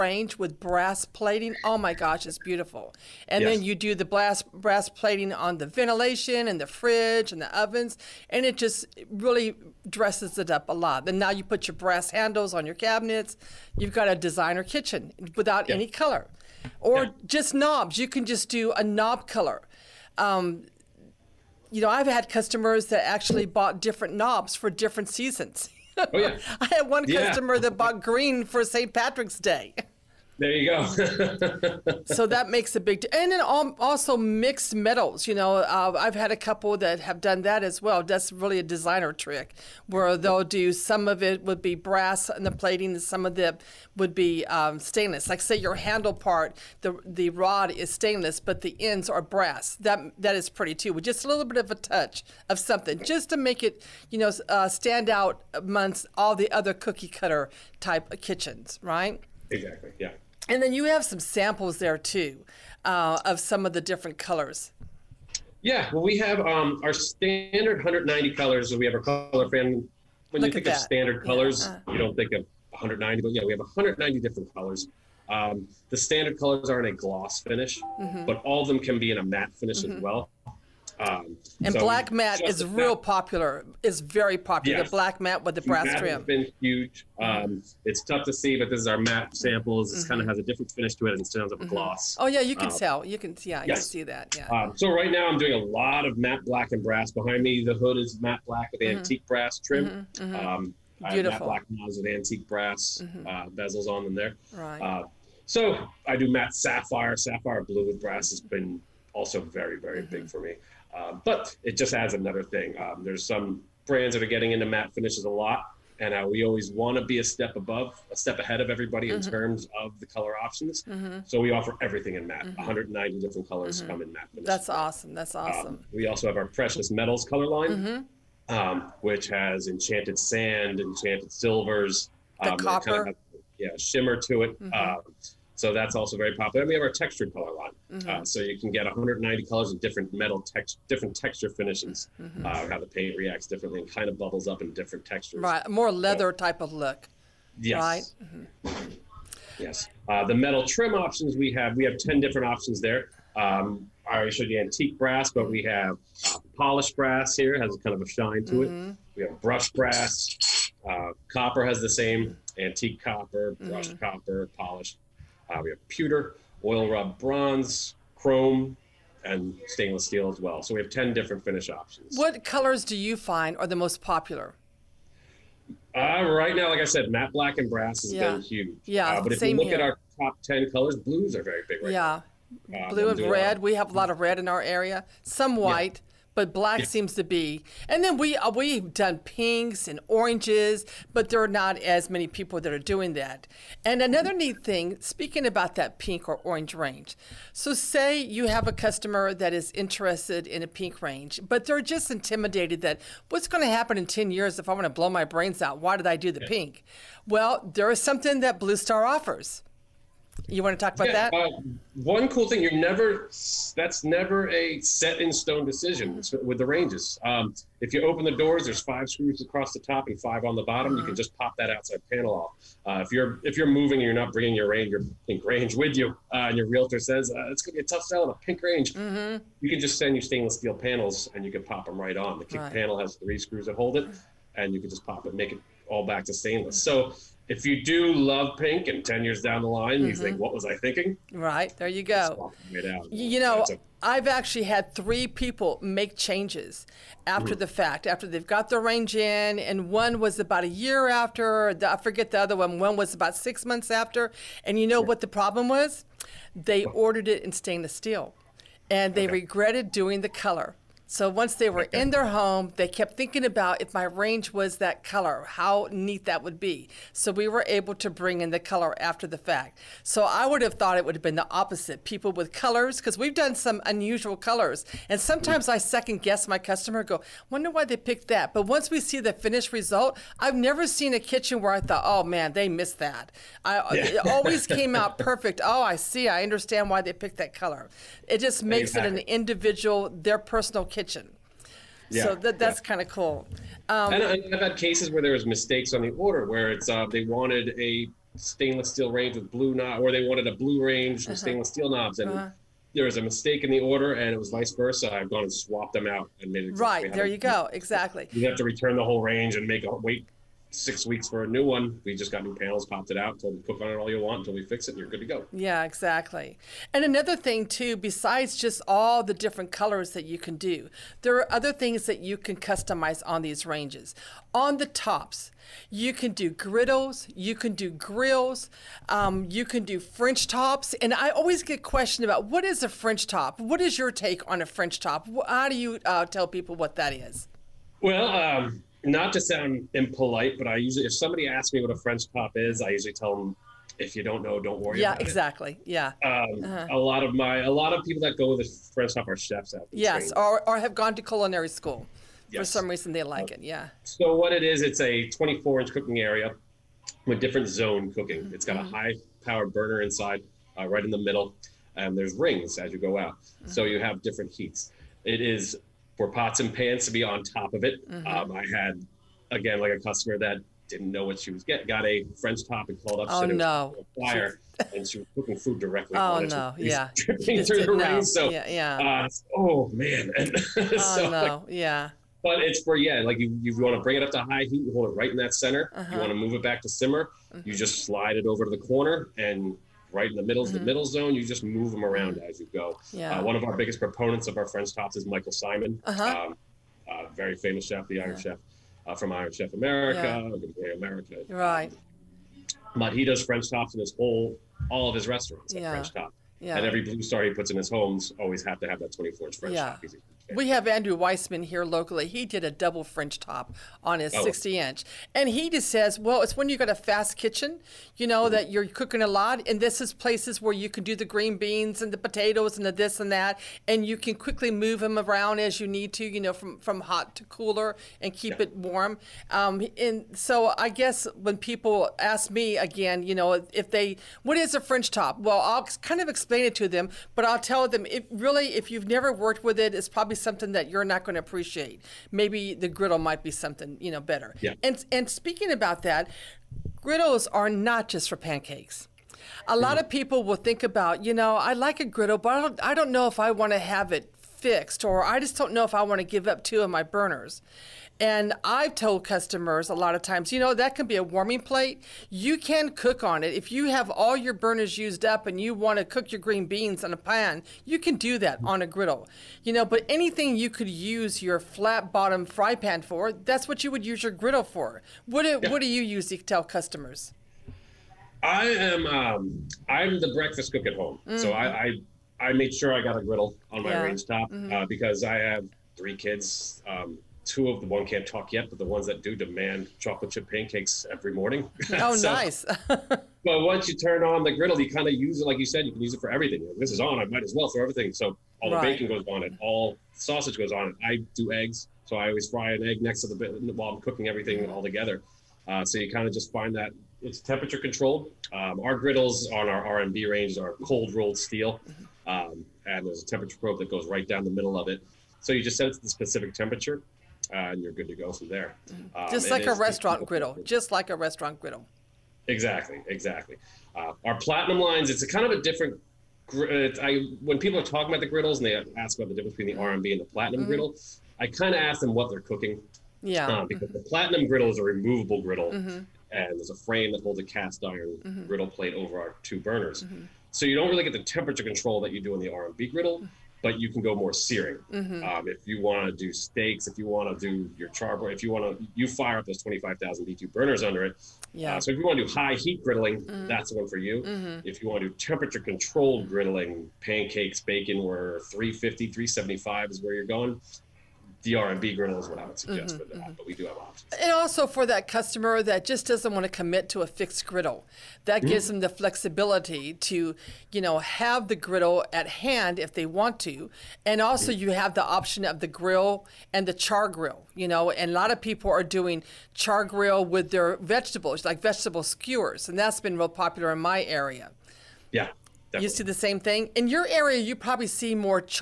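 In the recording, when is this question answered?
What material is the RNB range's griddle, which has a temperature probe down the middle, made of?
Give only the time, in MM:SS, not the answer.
08:30.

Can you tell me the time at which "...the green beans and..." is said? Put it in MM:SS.
07:01.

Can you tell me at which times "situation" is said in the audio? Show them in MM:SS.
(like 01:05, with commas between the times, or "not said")
not said.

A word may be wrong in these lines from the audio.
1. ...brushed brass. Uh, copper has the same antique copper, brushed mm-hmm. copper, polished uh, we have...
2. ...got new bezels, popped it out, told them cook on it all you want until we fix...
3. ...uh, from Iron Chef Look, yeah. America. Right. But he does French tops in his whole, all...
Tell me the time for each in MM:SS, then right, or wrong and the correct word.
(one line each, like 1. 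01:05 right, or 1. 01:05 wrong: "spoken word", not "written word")
1. 02:39 right
2. 05:12 wrong: "panels", not "bezels"
3. 06:39 wrong: "America", not "Look".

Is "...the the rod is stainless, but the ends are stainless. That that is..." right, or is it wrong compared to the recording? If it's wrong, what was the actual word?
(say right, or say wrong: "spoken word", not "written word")
wrong: "brass", not "stainless".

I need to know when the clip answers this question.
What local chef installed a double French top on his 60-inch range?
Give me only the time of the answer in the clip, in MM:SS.
06:50.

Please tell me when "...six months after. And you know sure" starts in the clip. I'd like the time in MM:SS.
04:13.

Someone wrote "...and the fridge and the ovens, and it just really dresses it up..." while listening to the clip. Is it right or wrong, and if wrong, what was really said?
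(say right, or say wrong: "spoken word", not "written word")
right.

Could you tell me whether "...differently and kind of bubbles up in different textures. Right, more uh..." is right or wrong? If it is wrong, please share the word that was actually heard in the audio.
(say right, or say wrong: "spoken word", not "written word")
right.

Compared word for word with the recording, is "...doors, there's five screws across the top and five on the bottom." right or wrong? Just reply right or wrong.
right.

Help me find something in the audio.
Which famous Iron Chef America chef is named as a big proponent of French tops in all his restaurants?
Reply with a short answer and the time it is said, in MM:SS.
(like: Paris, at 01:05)
Michael Symon, at 06:35.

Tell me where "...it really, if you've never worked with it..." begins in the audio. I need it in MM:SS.
07:18.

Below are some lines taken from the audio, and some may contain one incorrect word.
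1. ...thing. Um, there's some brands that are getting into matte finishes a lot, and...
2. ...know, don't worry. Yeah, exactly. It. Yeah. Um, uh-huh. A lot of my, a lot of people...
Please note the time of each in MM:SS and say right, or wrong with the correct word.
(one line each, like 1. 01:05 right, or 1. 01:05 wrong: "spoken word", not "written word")
1. 01:52 right
2. 05:44 right.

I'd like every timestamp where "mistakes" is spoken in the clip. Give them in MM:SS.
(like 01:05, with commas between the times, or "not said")
04:55, 05:03.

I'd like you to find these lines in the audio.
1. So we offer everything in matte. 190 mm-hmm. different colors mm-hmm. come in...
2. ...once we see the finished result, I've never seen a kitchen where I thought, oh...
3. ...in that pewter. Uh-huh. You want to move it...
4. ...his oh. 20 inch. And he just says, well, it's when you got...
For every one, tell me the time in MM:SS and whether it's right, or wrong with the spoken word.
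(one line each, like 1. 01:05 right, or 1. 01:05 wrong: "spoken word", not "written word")
1. 02:01 right
2. 04:38 right
3. 06:25 wrong: "center", not "pewter"
4. 06:54 wrong: "60", not "20".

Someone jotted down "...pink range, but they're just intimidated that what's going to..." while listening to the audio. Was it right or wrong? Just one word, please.
right.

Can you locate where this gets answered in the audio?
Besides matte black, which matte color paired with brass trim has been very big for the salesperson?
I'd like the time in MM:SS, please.
01:47.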